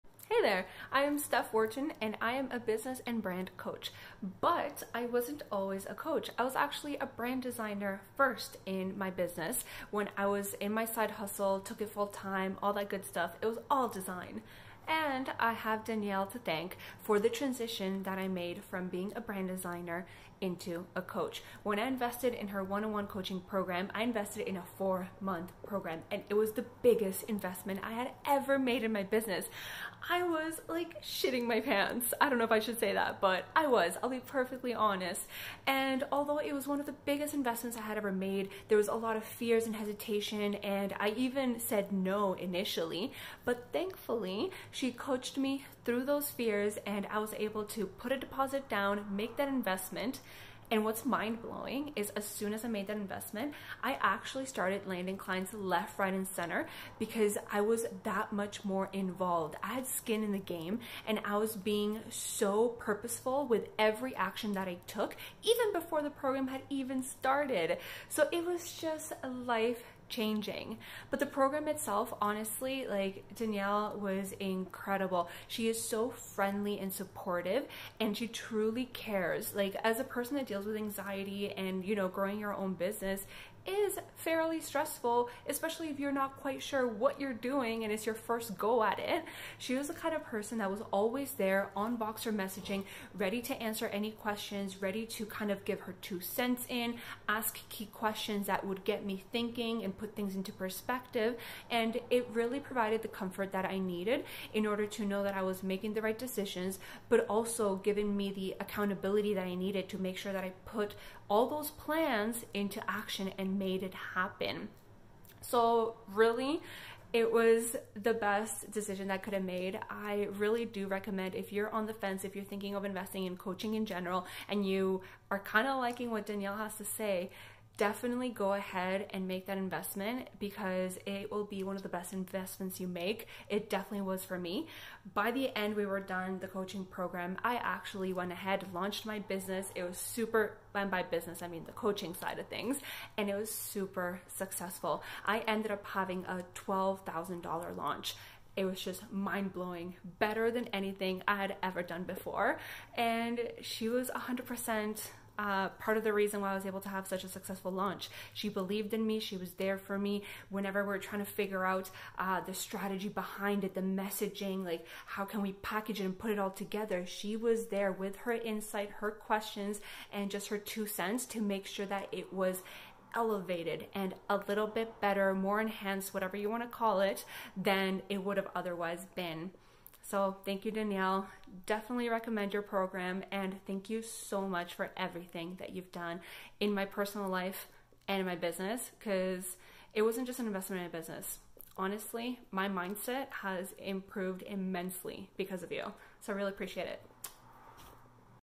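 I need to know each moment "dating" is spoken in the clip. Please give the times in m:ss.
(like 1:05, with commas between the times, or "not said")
not said.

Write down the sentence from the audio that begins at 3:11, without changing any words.
Honestly, my mindset has improved immensely because of you.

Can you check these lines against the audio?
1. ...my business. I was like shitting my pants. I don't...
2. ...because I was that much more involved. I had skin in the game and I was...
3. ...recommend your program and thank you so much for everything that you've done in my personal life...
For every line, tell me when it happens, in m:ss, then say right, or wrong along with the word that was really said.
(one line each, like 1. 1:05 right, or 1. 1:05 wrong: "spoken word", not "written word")
1. 0:28 right
2. 0:56 right
3. 3:02 right.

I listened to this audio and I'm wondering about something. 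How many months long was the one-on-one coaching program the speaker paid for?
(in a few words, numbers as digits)
4 months.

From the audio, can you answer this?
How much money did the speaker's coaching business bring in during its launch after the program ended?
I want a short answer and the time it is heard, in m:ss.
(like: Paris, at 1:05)
$12,000, at 2:26.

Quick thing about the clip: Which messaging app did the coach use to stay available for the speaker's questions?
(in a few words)
Voxer.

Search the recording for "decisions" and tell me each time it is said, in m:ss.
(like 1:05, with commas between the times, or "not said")
1:46, 1:58.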